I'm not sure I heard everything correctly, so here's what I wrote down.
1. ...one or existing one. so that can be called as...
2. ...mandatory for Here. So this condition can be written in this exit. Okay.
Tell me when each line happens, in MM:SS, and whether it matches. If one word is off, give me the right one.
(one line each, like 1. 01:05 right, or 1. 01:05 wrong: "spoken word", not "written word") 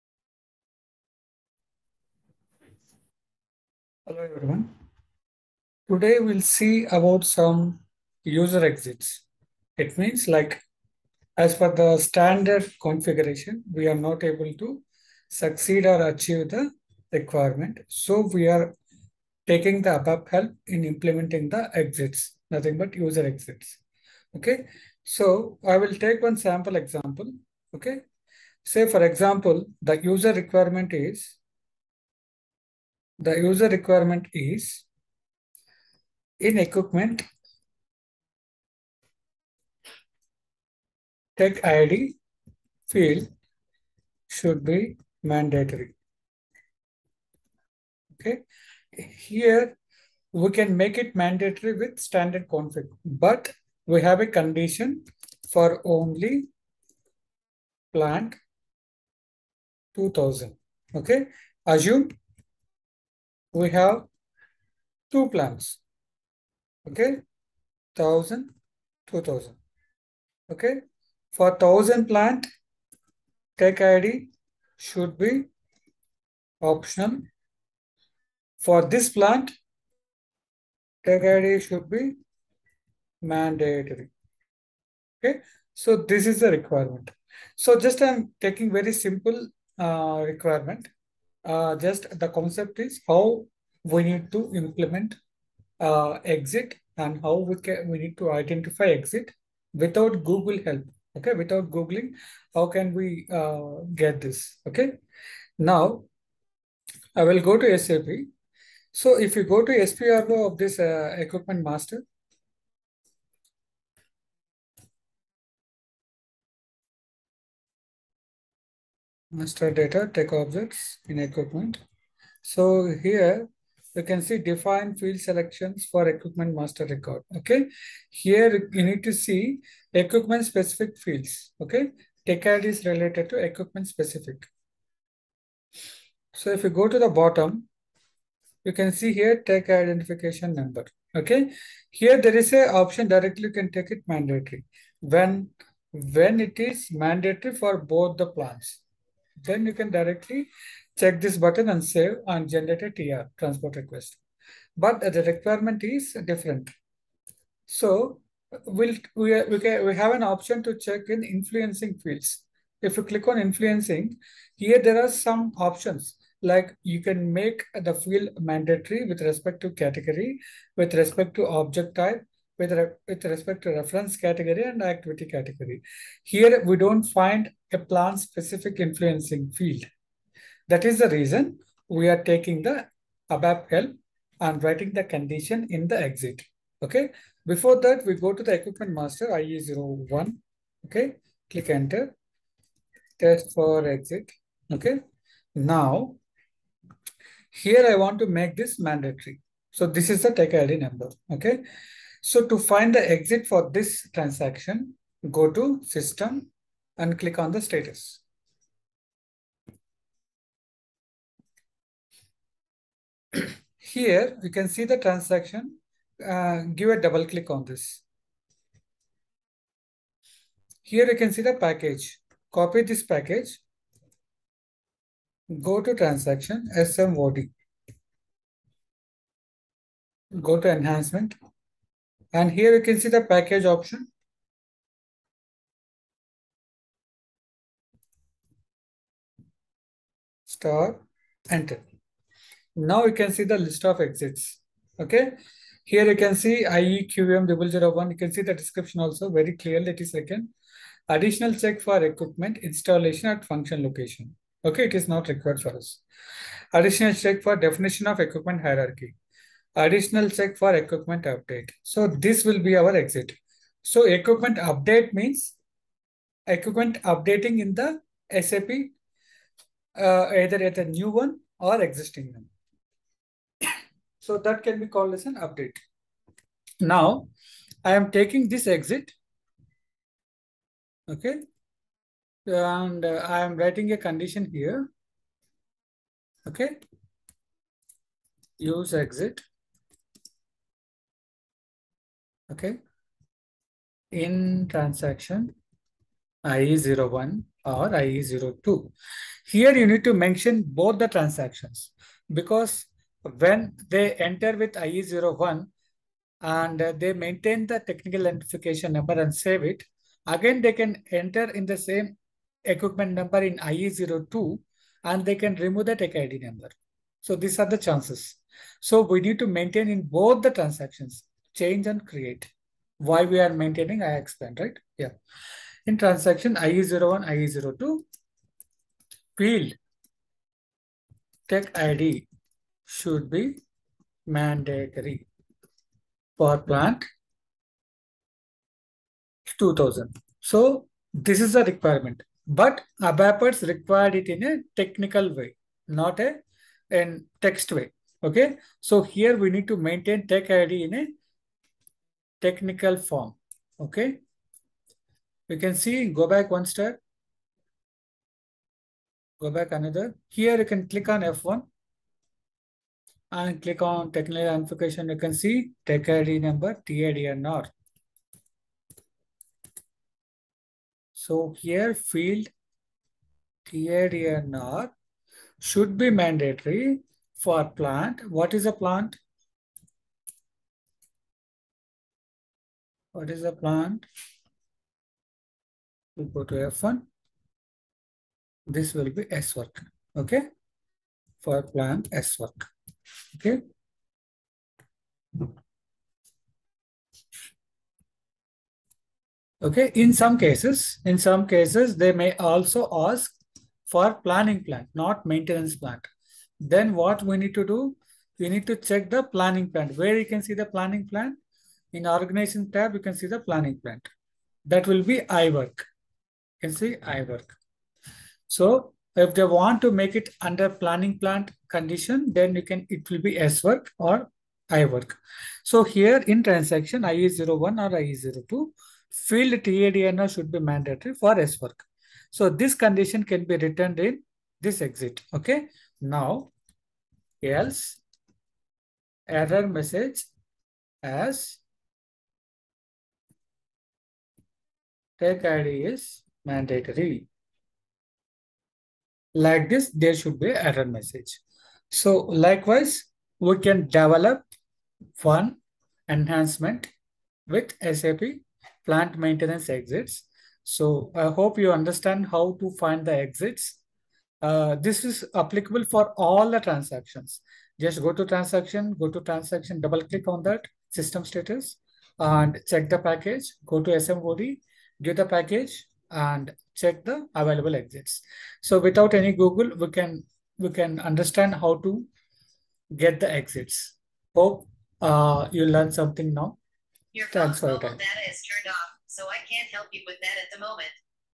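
1. 04:31 right
2. 07:10 wrong: "SWERK", not "Here".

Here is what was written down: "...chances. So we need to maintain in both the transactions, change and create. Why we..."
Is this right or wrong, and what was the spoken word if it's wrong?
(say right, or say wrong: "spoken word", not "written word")
right.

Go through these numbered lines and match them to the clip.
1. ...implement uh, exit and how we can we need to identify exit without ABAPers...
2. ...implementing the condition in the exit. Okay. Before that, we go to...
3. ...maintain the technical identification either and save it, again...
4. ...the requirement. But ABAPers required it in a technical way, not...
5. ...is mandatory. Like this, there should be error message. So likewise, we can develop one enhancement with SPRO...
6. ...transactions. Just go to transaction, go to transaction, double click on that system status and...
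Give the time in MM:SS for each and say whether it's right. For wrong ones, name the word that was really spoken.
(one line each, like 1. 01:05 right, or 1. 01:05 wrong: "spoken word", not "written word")
1. 01:34 wrong: "Google", not "ABAPers"
2. 03:04 wrong: "writing", not "implementing"
3. 05:07 wrong: "number", not "either"
4. 05:41 right
5. 07:25 wrong: "SAP", not "SPRO"
6. 07:46 right.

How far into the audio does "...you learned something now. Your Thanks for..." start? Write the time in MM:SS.
08:05.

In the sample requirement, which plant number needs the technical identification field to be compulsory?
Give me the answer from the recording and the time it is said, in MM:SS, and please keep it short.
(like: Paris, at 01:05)
2000, at 01:09.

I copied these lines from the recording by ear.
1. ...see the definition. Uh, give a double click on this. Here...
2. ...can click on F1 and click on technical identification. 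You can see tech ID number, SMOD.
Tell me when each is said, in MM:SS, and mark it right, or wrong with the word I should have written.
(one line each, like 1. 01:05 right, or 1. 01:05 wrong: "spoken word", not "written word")
1. 03:34 wrong: "transaction", not "definition"
2. 06:00 wrong: "TIDNR", not "SMOD".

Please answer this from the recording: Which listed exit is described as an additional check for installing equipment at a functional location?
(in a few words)
IEQM001.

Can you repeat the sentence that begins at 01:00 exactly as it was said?
Okay, assume we have two plans.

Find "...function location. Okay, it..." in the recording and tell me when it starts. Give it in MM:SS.
04:13.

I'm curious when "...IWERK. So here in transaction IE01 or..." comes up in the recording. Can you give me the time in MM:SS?
07:04.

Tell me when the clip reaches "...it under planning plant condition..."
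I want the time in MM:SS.
07:00.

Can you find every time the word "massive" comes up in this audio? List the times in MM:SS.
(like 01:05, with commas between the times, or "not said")
not said.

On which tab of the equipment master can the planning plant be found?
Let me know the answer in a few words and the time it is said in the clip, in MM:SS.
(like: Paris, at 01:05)
Organization, at 06:52.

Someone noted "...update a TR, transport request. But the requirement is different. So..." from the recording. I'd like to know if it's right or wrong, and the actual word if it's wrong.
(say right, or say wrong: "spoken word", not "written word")
wrong: "generate", not "update".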